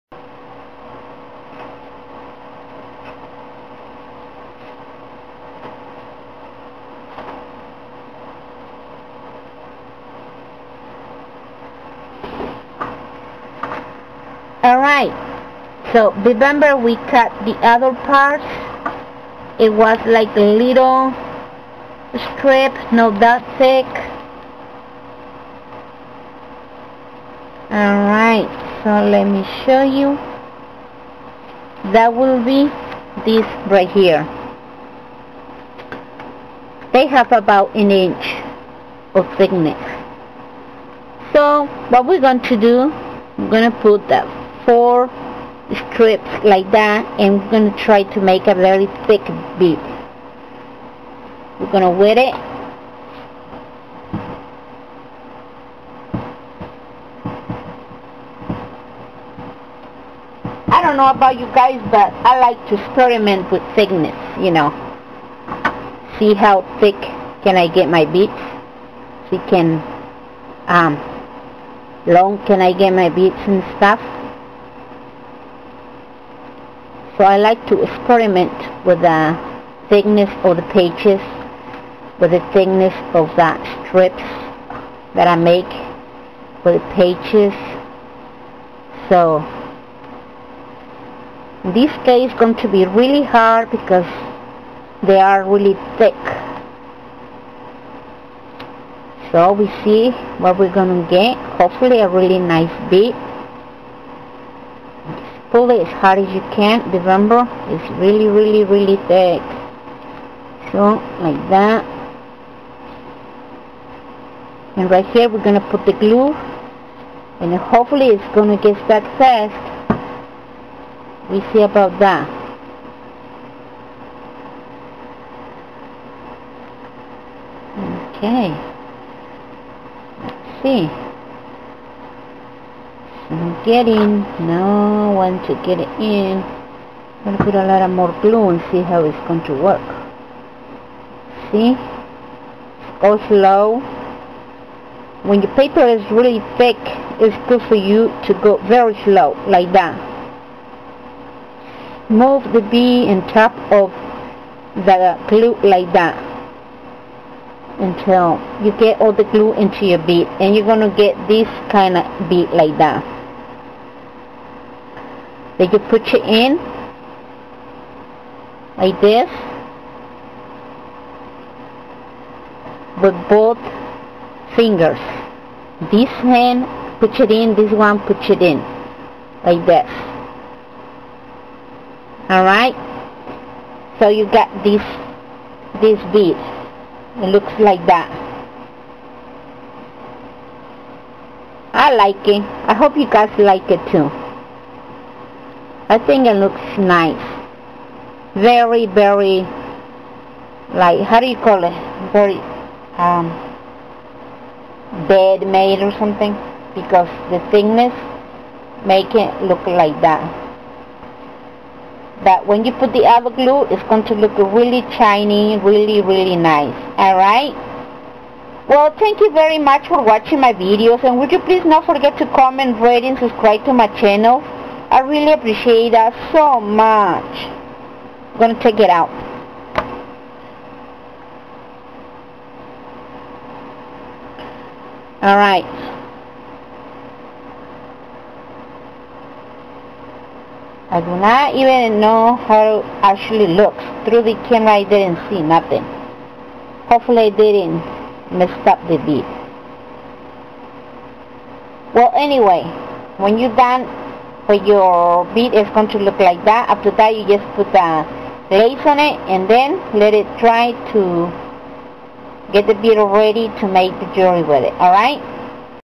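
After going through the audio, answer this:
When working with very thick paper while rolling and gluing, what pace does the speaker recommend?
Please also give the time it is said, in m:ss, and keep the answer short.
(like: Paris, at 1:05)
very slow, at 2:28.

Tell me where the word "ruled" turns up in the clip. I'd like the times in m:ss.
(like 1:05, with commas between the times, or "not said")
not said.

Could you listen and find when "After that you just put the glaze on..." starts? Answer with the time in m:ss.
4:16.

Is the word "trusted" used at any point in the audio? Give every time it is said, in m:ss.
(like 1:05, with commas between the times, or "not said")
not said.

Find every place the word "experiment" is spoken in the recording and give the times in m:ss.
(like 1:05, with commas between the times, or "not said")
1:02, 1:17.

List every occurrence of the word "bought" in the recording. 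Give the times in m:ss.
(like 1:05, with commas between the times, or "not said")
not said.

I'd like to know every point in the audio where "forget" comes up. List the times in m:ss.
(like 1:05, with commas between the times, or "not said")
3:41.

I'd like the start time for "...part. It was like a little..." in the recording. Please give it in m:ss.
0:18.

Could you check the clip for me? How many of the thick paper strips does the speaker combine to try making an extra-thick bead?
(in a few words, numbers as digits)
4.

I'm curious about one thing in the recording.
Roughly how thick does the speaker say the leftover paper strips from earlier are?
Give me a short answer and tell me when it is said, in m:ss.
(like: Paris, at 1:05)
about an inch, at 0:37.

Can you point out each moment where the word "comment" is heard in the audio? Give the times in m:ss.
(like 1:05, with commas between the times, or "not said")
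3:42.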